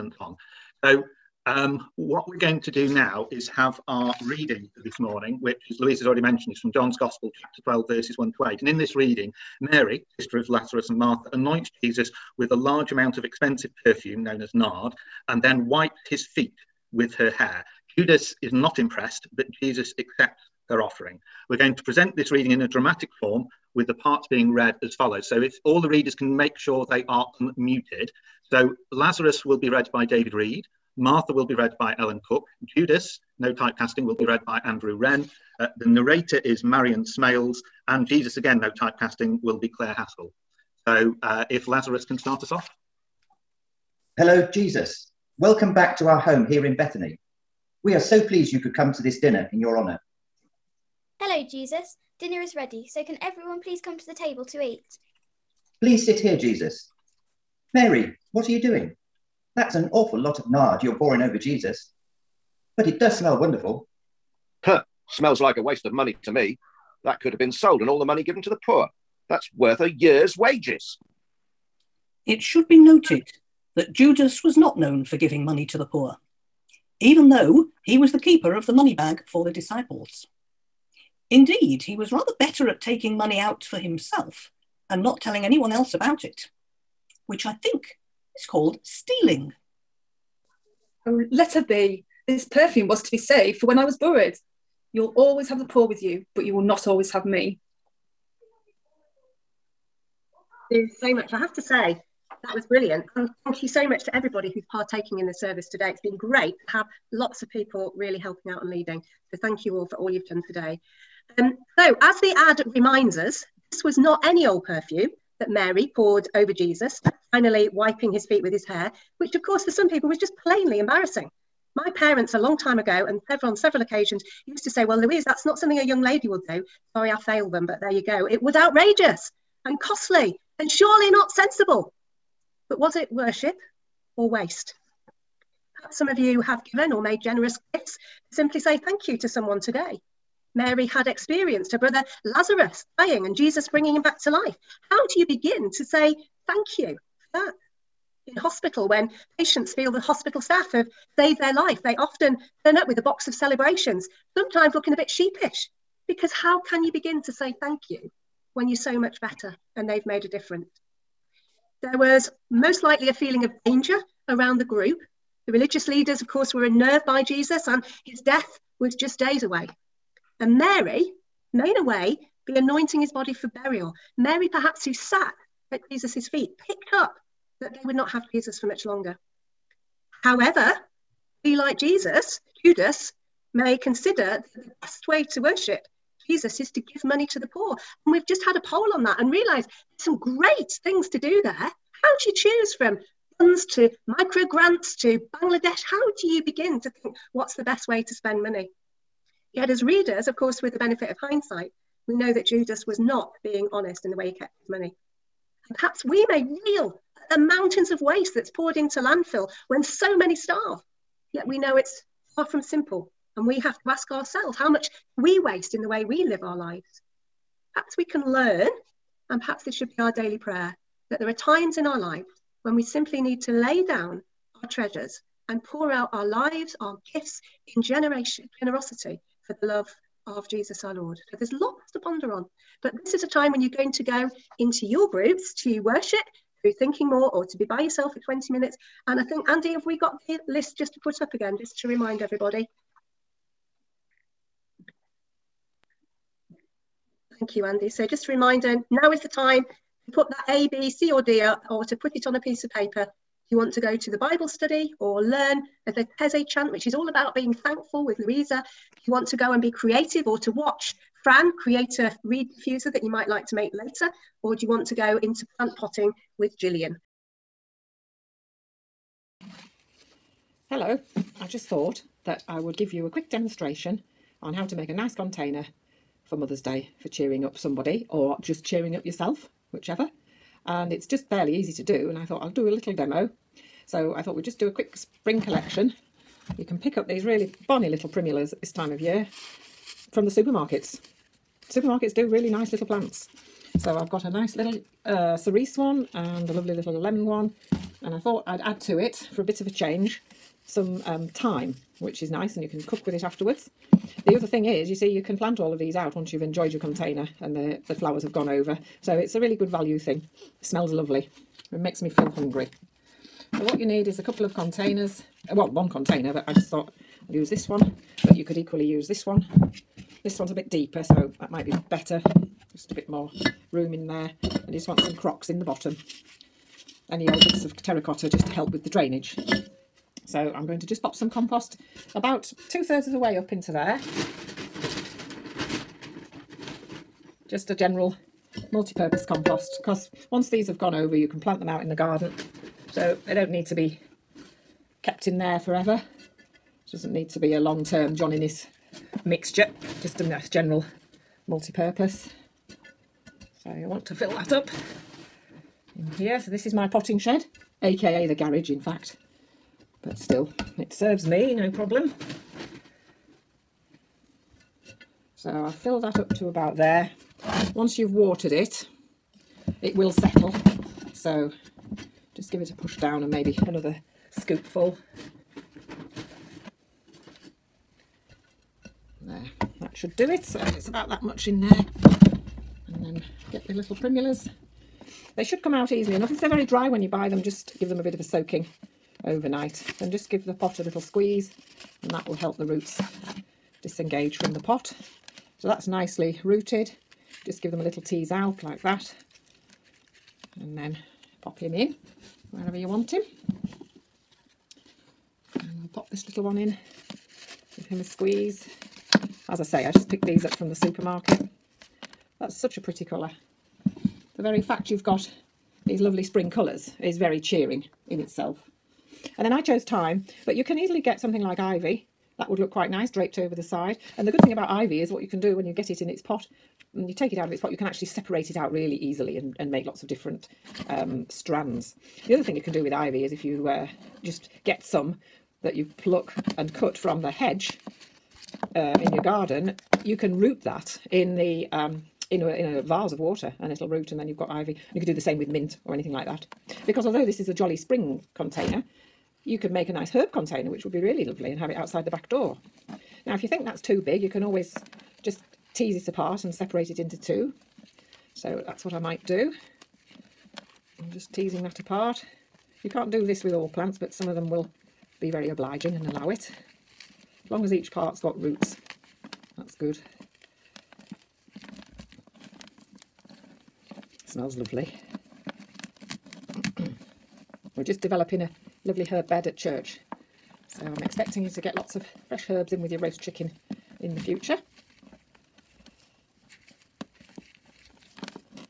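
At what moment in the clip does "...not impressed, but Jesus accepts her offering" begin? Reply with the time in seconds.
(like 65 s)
18 s.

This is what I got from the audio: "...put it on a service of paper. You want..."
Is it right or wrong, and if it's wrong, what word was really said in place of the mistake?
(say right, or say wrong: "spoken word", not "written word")
wrong: "piece", not "service".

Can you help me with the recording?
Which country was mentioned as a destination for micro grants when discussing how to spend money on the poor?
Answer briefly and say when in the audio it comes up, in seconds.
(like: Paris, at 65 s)
Bangladesh, at 195 s.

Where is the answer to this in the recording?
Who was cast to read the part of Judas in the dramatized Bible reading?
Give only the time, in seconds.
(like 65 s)
34 s.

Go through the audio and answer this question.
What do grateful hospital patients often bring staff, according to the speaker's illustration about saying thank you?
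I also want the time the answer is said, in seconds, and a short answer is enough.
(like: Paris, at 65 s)
A box of Celebrations, at 152 s.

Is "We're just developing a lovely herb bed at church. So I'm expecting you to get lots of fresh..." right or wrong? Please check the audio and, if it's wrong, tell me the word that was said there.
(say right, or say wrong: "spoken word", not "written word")
right.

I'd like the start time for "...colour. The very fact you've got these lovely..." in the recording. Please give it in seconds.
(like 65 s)
413 s.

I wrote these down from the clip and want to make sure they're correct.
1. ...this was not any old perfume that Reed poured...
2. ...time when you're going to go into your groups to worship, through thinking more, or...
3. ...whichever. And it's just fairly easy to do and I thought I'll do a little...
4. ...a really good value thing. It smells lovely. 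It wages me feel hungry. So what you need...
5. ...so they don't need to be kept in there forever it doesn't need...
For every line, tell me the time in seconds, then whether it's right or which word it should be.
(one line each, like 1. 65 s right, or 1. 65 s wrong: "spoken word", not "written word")
1. 113 s wrong: "Mary", not "Reed"
2. 233 s right
3. 279 s right
4. 309 s wrong: "makes", not "wages"
5. 342 s right.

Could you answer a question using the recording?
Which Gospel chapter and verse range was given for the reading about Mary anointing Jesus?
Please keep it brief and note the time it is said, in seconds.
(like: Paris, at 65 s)
Chapter 12, verses 1 to 8, at 7 s.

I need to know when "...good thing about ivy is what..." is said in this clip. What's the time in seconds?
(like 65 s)
424 s.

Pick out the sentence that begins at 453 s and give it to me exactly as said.
Now, if you think that's too big, you can always just tease it apart and separate it into two.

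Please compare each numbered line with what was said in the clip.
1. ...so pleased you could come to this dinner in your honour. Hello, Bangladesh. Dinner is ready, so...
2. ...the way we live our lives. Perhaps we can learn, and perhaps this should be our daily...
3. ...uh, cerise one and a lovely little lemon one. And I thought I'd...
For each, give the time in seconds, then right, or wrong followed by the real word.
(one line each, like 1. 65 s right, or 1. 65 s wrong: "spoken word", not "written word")
1. 47 s wrong: "Jesus", not "Bangladesh"
2. 215 s right
3. 295 s right.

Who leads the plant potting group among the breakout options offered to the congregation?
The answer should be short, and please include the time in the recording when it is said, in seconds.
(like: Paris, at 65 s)
Gillian, at 266 s.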